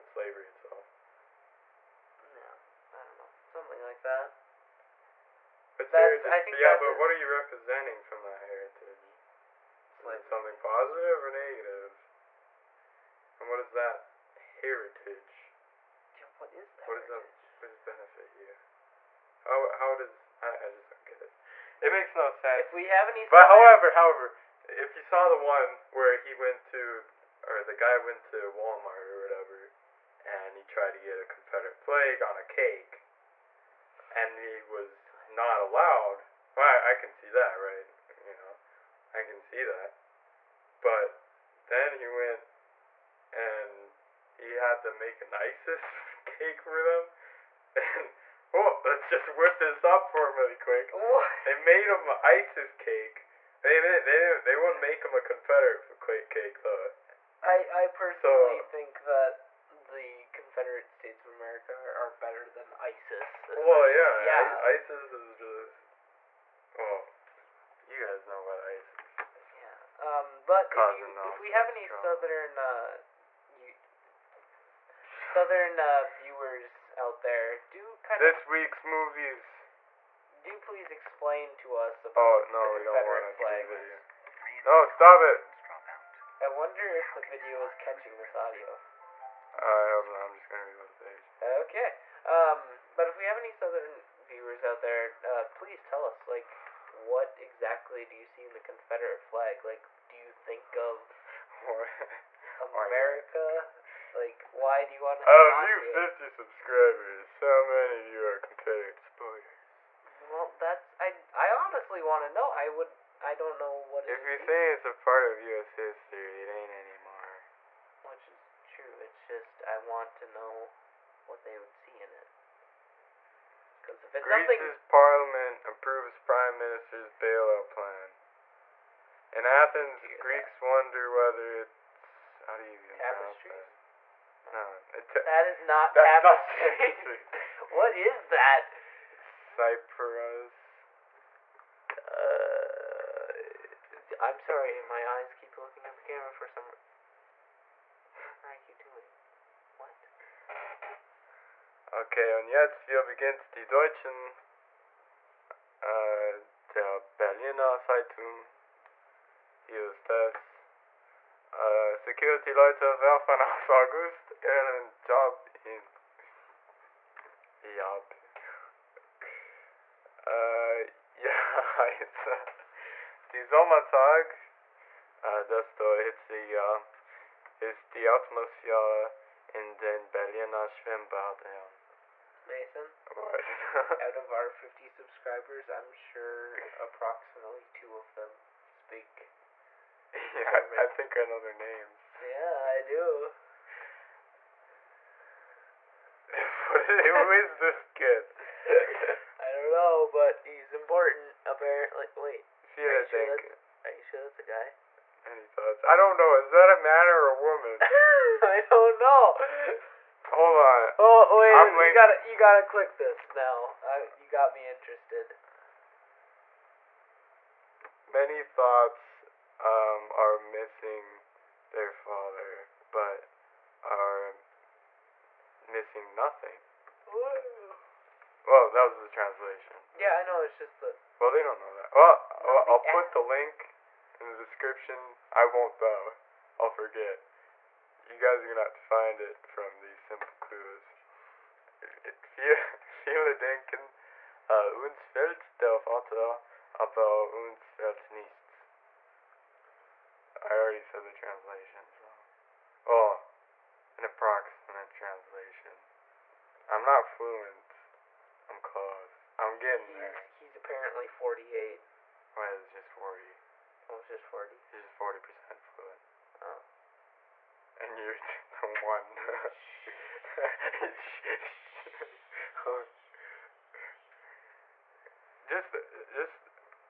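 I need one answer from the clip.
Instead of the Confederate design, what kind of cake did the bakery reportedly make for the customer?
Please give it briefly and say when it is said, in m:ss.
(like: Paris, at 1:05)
ISIS cake, at 0:45.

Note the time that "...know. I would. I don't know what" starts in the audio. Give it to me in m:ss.
1:52.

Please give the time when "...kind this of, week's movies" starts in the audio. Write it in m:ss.
1:18.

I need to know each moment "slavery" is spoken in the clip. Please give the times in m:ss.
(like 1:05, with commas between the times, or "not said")
0:00, 0:09.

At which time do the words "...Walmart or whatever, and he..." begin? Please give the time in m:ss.
0:28.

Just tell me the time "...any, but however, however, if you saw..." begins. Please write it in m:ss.
0:23.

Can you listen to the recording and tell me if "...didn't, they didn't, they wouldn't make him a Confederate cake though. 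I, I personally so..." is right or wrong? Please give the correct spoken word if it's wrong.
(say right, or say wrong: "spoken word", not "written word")
right.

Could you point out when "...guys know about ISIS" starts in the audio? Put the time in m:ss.
1:08.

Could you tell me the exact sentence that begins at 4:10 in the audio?
I already said the translation, so.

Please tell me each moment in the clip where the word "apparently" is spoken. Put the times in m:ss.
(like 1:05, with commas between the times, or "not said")
3:21, 4:20.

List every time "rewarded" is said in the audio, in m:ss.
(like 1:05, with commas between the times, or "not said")
not said.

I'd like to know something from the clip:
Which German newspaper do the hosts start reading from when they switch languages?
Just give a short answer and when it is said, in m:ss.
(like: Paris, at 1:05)
Berliner Zeitung, at 2:37.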